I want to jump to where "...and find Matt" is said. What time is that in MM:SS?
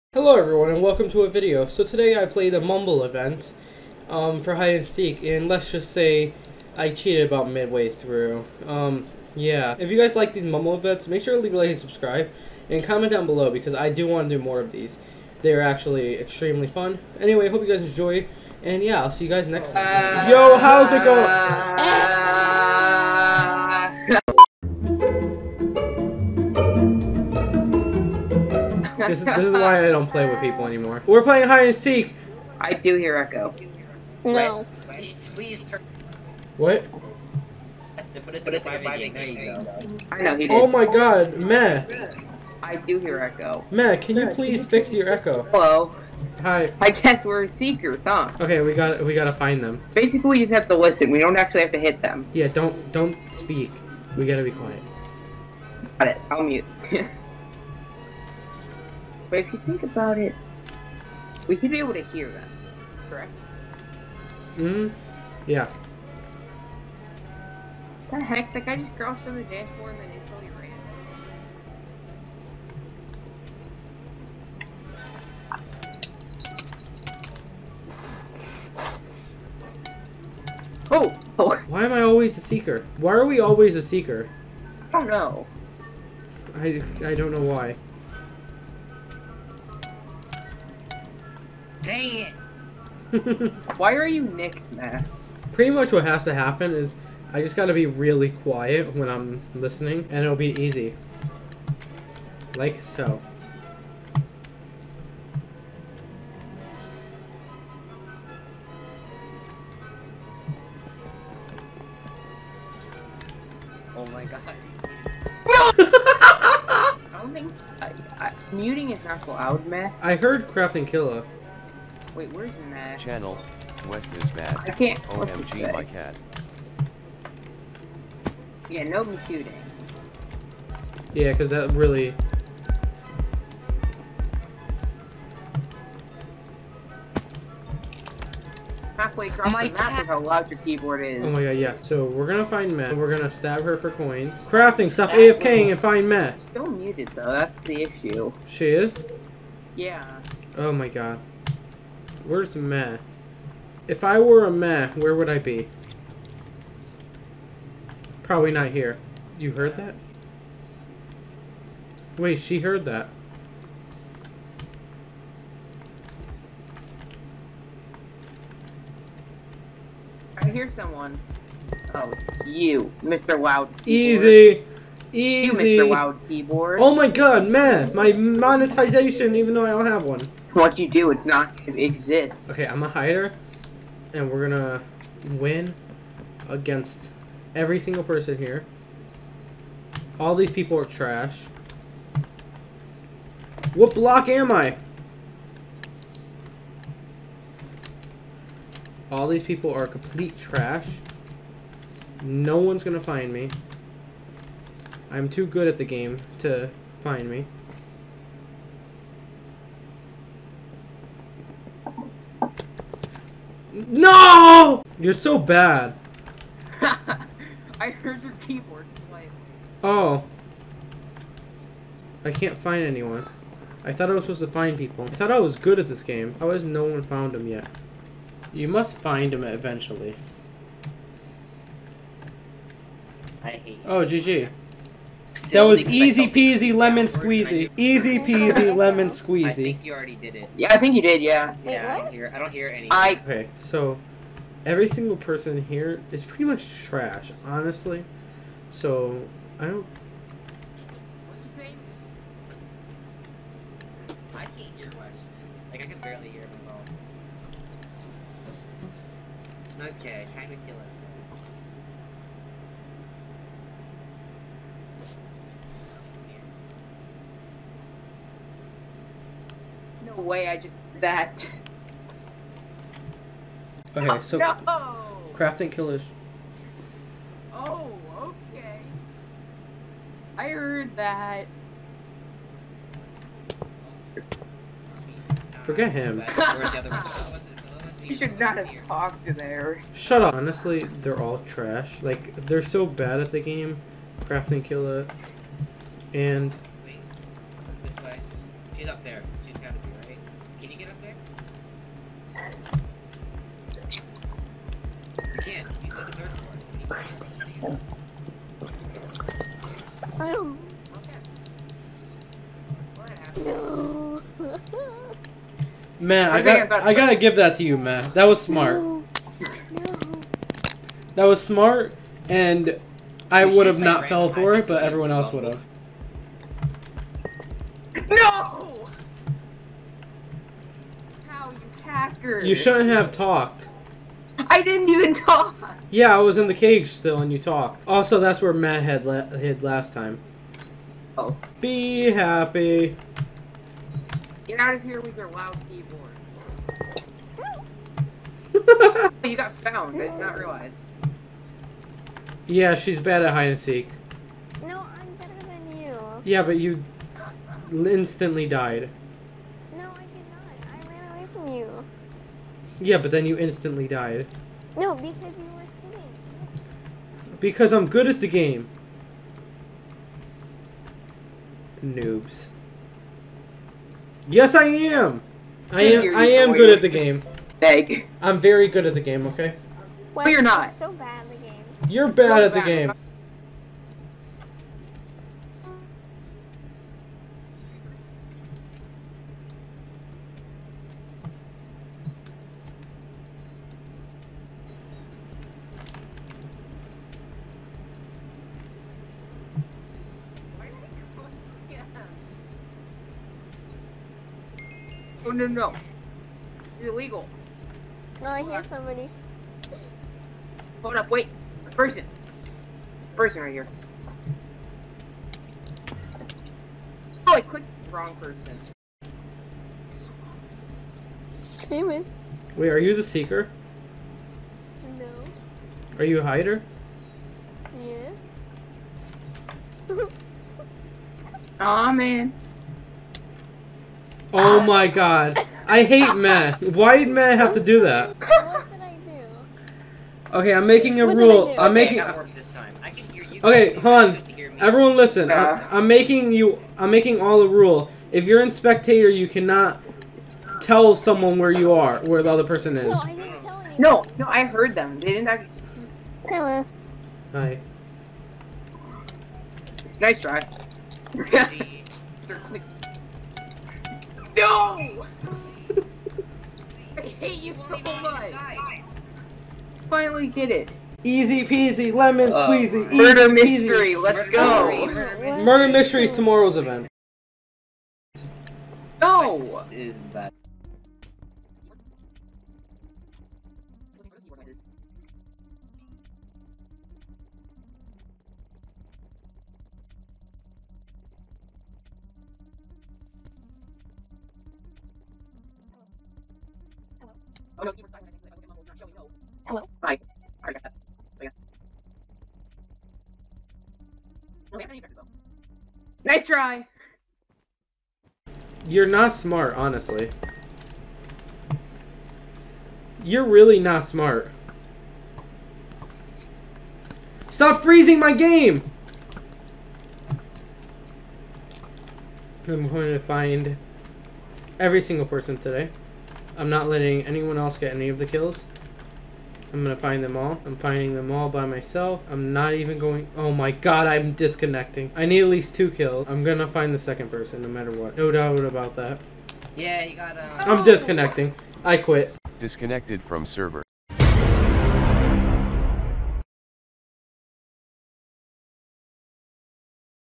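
02:25.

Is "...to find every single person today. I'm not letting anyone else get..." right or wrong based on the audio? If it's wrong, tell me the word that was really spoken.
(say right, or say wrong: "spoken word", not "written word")
right.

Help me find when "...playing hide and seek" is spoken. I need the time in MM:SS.
00:31.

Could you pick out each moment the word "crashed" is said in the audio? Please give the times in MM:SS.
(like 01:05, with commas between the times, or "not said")
not said.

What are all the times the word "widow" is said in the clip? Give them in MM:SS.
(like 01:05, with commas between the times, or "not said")
not said.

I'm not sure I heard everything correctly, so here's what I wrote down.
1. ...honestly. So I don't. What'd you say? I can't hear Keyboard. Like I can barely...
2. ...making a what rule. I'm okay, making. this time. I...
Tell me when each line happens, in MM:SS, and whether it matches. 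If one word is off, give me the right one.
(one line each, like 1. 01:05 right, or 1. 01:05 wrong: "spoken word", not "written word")
1. 04:07 wrong: "West", not "Keyboard"
2. 07:20 right.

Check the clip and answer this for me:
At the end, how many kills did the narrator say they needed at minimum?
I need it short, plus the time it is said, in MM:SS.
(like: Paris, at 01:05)
2, at 08:55.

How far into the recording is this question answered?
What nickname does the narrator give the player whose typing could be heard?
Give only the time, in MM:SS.
02:55.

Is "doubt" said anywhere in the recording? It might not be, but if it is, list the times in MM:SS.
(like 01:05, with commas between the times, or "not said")
08:58.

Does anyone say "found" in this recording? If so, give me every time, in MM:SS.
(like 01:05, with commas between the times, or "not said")
03:47, 05:49.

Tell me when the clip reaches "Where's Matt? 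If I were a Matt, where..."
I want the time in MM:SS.
02:32.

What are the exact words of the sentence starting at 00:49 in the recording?
Basically, we just have to listen.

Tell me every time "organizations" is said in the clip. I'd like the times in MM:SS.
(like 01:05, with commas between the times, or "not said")
not said.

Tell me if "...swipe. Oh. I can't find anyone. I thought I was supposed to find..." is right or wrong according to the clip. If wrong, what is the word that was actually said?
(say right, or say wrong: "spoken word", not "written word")
right.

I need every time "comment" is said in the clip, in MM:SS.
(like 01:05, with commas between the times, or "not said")
00:12.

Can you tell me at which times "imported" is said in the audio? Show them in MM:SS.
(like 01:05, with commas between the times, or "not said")
not said.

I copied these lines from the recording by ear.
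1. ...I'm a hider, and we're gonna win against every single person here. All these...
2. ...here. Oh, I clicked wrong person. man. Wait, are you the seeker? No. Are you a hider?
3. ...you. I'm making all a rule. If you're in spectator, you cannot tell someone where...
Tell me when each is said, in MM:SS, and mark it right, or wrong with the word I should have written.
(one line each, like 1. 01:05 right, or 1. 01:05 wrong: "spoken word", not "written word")
1. 03:02 right
2. 06:53 right
3. 07:26 right.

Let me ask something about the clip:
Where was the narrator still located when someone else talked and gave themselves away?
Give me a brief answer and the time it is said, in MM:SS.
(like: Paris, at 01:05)
The cage, at 05:36.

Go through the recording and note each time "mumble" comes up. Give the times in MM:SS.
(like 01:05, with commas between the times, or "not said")
00:02, 00:10.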